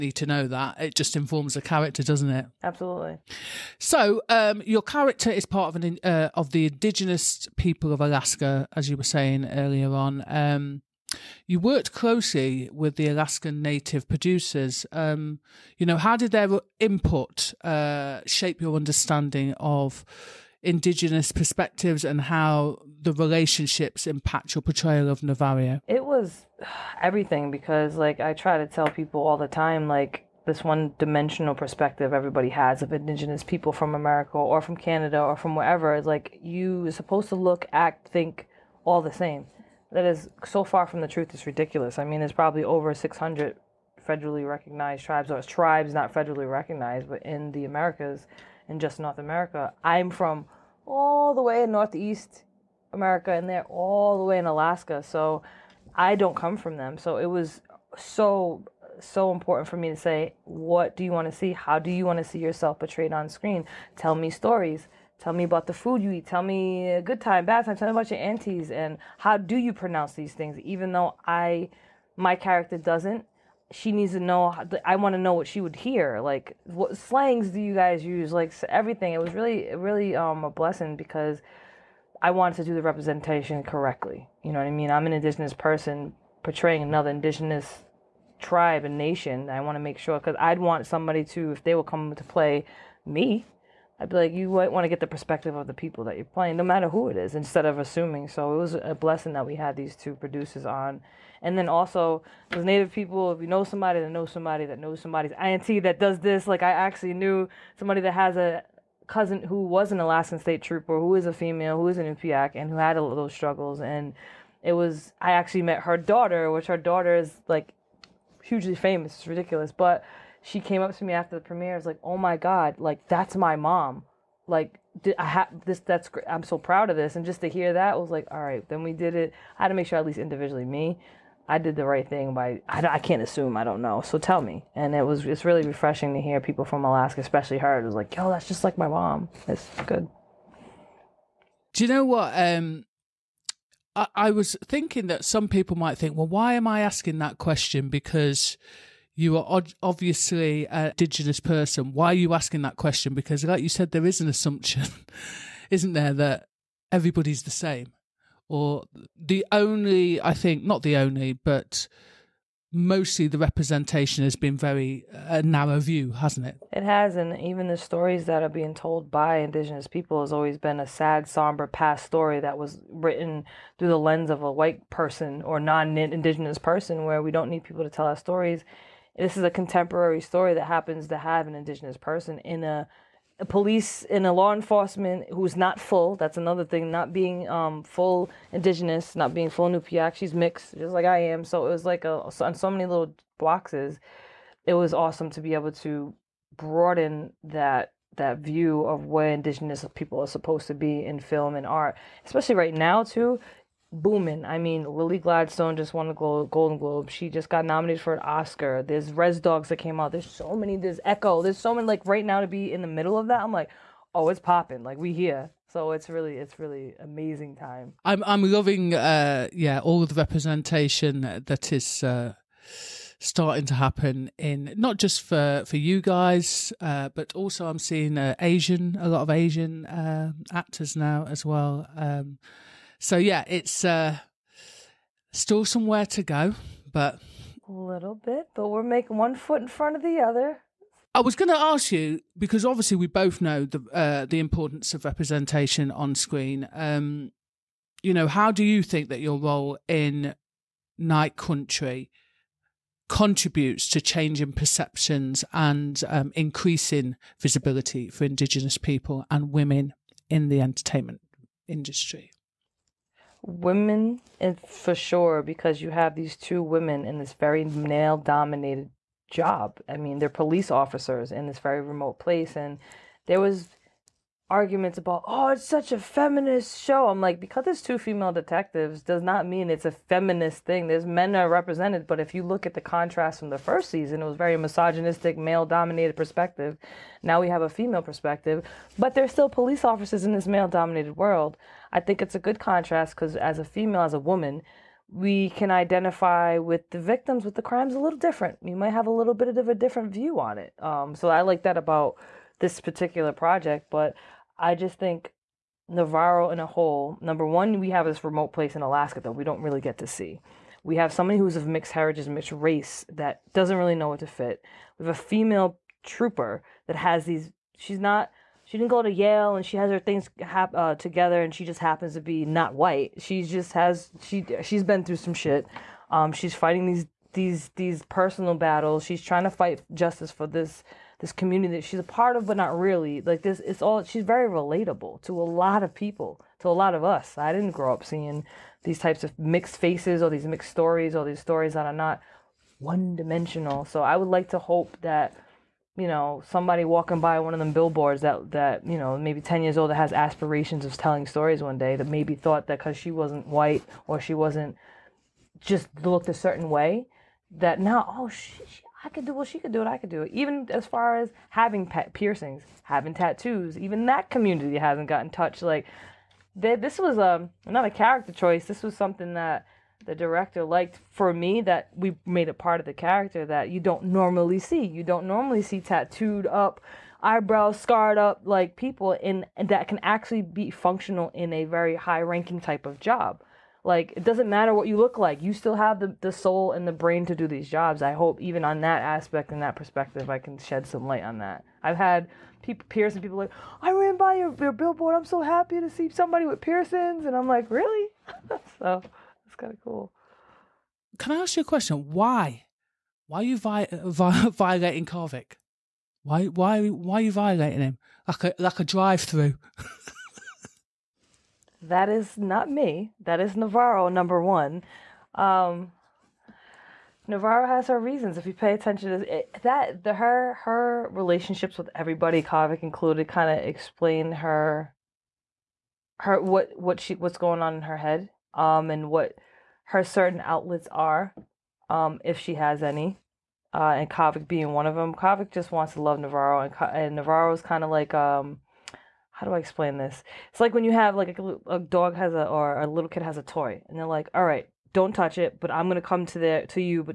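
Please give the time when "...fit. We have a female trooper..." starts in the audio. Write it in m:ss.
5:14.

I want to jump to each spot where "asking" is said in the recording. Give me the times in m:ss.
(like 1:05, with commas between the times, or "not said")
2:26, 2:32.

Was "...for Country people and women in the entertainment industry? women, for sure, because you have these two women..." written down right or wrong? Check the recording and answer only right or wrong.
wrong.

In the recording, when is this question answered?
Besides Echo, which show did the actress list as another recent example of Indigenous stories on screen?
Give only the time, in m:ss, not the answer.
3:29.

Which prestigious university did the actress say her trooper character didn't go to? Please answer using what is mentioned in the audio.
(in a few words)
Yale.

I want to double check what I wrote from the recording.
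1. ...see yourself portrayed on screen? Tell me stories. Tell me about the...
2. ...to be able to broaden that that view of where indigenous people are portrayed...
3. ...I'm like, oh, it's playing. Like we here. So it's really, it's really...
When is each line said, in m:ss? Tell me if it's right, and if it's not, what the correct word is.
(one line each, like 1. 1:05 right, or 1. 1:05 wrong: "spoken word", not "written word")
1. 1:02 right
2. 3:15 wrong: "supposed", not "portrayed"
3. 3:33 wrong: "popping", not "playing".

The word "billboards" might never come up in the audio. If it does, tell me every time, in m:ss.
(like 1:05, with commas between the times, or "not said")
5:47, 6:34.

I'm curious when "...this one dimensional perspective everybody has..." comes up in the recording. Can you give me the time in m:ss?
0:30.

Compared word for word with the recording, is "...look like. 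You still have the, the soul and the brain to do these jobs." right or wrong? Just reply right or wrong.
right.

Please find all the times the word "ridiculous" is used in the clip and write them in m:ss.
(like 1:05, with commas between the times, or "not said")
0:41, 1:59.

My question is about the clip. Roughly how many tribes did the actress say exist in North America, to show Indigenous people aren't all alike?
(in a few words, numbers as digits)
over 600.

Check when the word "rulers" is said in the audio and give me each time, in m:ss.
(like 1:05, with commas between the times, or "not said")
not said.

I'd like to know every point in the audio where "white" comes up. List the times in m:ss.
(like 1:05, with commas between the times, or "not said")
2:54, 5:22, 5:53.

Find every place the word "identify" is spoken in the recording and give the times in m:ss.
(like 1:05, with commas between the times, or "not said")
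4:55.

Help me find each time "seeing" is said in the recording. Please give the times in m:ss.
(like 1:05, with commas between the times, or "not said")
3:47, 5:38.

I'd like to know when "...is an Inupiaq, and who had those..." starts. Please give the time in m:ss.
1:51.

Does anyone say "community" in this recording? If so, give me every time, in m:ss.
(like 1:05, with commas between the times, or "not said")
5:31, 6:04.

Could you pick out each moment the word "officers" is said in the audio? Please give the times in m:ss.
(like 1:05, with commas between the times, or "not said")
4:30, 4:49.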